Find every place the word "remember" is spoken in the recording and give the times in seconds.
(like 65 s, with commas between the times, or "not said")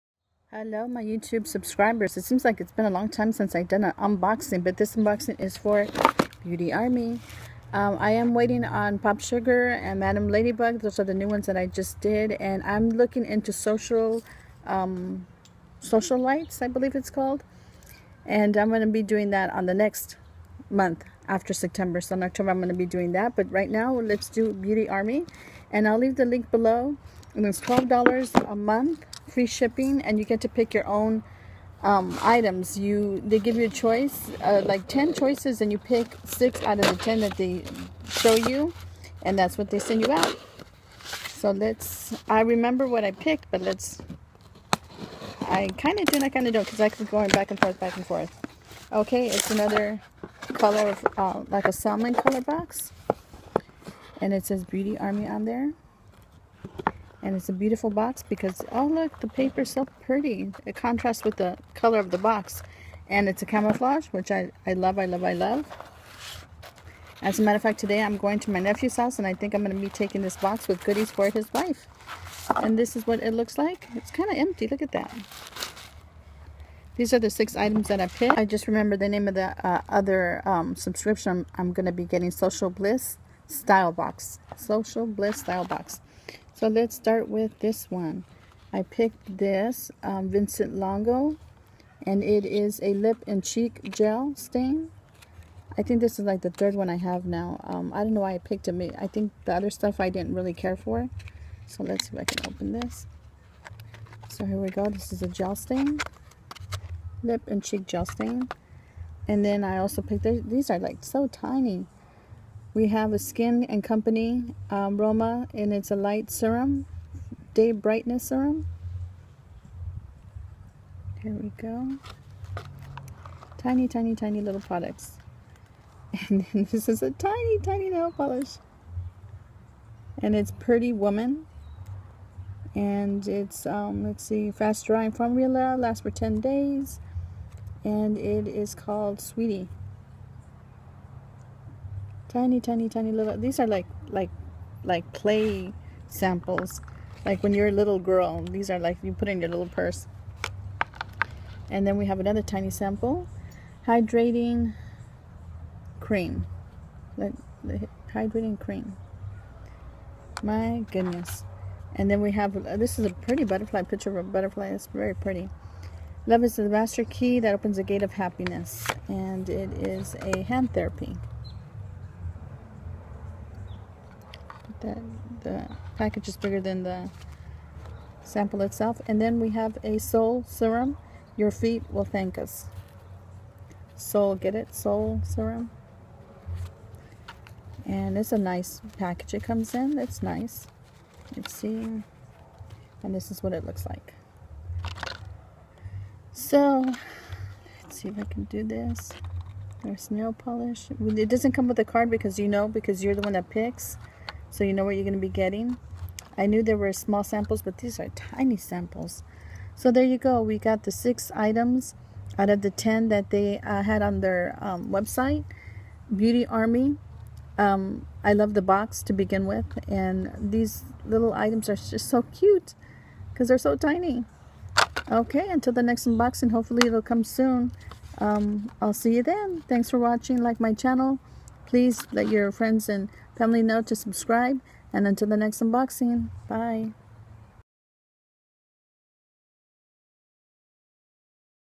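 42 s, 78 s.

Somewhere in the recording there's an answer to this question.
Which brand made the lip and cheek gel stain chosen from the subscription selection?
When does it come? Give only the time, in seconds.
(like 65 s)
90 s.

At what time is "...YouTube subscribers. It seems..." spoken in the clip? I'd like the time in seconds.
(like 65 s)
1 s.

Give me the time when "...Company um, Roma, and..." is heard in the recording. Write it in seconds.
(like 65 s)
113 s.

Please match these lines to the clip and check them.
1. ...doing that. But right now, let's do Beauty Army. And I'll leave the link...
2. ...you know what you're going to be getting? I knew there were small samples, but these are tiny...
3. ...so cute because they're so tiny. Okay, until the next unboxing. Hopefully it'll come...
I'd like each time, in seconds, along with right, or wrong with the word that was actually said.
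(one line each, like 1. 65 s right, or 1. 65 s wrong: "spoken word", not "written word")
1. 22 s right
2. 204 s right
3. 222 s right.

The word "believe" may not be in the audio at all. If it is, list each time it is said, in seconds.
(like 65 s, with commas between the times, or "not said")
16 s.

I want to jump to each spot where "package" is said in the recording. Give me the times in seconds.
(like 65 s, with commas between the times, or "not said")
175 s, 188 s.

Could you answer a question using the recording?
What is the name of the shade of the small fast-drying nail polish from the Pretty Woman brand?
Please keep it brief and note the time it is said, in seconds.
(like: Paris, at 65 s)
Sweetie, at 139 s.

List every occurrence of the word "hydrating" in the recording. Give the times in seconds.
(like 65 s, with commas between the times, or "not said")
153 s, 158 s.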